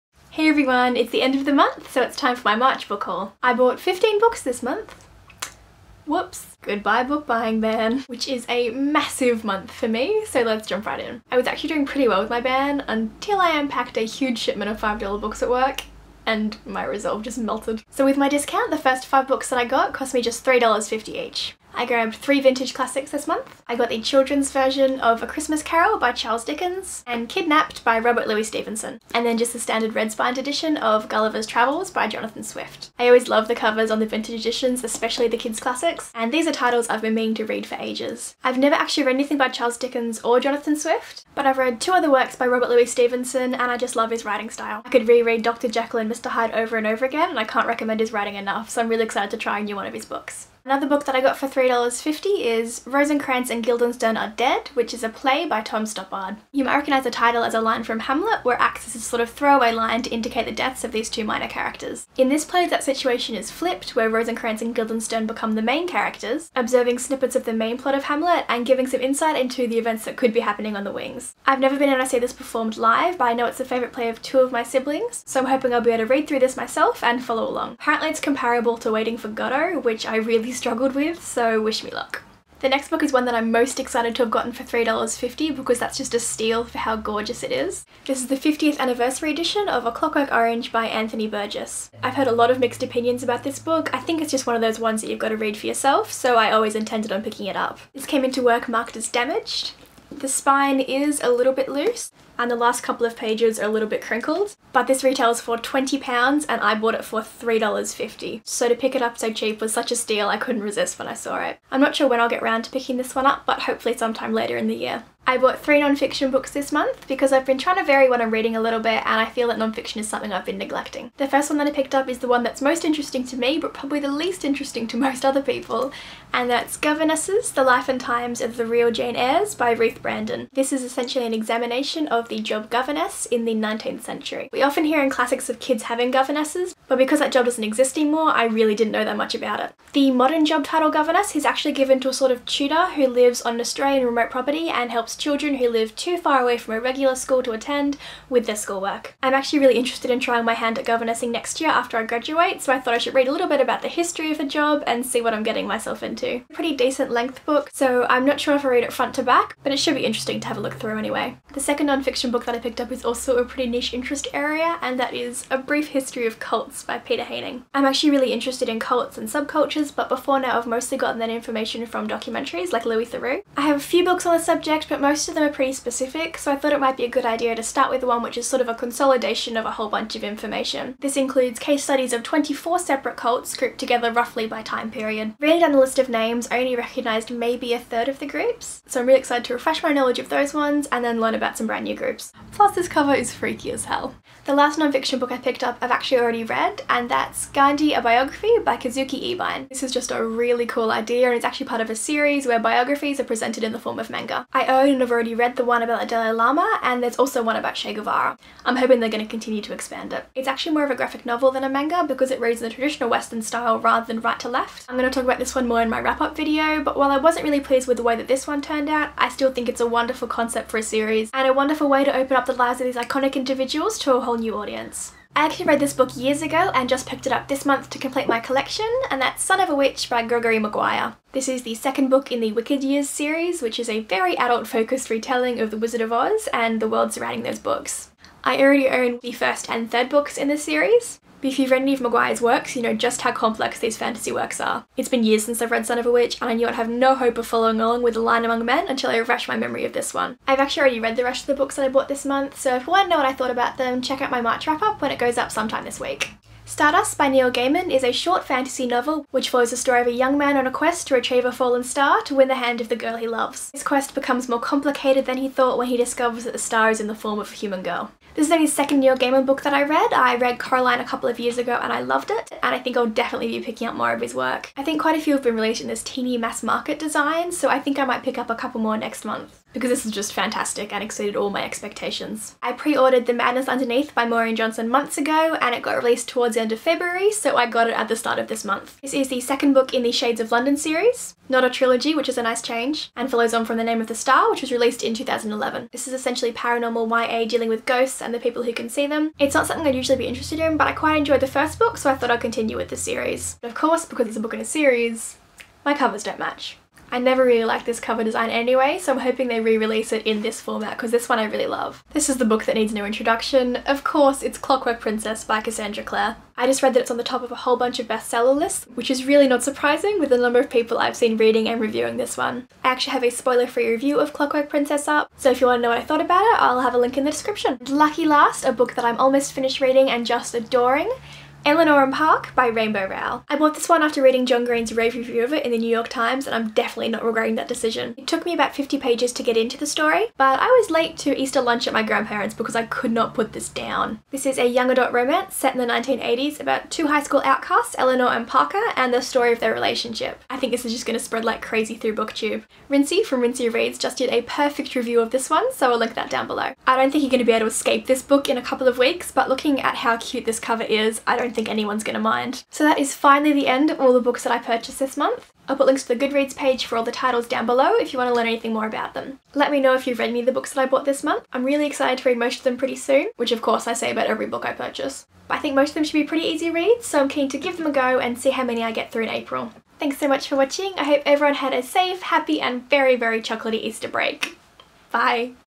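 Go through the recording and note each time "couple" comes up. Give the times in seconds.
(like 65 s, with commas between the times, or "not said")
102 s, 271 s, 278 s, 358 s.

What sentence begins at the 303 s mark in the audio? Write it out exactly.
But of course because it's a book in a series, my covers don't match.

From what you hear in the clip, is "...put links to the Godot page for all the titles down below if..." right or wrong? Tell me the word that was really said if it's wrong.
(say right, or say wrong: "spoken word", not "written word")
wrong: "Goodreads", not "Godot".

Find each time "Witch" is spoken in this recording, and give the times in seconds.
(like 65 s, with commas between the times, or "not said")
229 s, 246 s.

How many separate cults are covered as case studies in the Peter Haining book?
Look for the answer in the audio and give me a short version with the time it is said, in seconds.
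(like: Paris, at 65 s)
24, at 182 s.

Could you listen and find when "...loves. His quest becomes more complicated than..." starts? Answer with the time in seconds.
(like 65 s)
263 s.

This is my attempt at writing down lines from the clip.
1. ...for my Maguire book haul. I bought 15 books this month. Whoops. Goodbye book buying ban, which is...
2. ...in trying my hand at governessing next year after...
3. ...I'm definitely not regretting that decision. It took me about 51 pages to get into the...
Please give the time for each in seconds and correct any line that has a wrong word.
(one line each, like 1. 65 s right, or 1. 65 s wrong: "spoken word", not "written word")
1. 2 s wrong: "March", not "Maguire"
2. 150 s right
3. 336 s wrong: "50", not "51".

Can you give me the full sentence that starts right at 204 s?
I own wouldn't have already read the one about the Dalai Lama and there's also one about Che Guevara.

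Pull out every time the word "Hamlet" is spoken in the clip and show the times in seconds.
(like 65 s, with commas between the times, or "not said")
58 s, 68 s.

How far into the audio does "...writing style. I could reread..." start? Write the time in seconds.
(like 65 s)
44 s.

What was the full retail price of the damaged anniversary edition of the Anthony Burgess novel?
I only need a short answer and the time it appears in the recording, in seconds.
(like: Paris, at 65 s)
£20, at 105 s.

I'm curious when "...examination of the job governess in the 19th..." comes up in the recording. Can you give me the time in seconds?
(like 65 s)
131 s.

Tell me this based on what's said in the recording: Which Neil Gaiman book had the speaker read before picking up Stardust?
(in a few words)
Coraline.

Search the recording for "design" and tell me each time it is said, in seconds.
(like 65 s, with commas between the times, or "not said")
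276 s, 308 s.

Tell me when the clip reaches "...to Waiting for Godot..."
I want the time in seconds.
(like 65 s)
78 s.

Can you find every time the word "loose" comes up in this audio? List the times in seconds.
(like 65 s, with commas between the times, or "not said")
101 s.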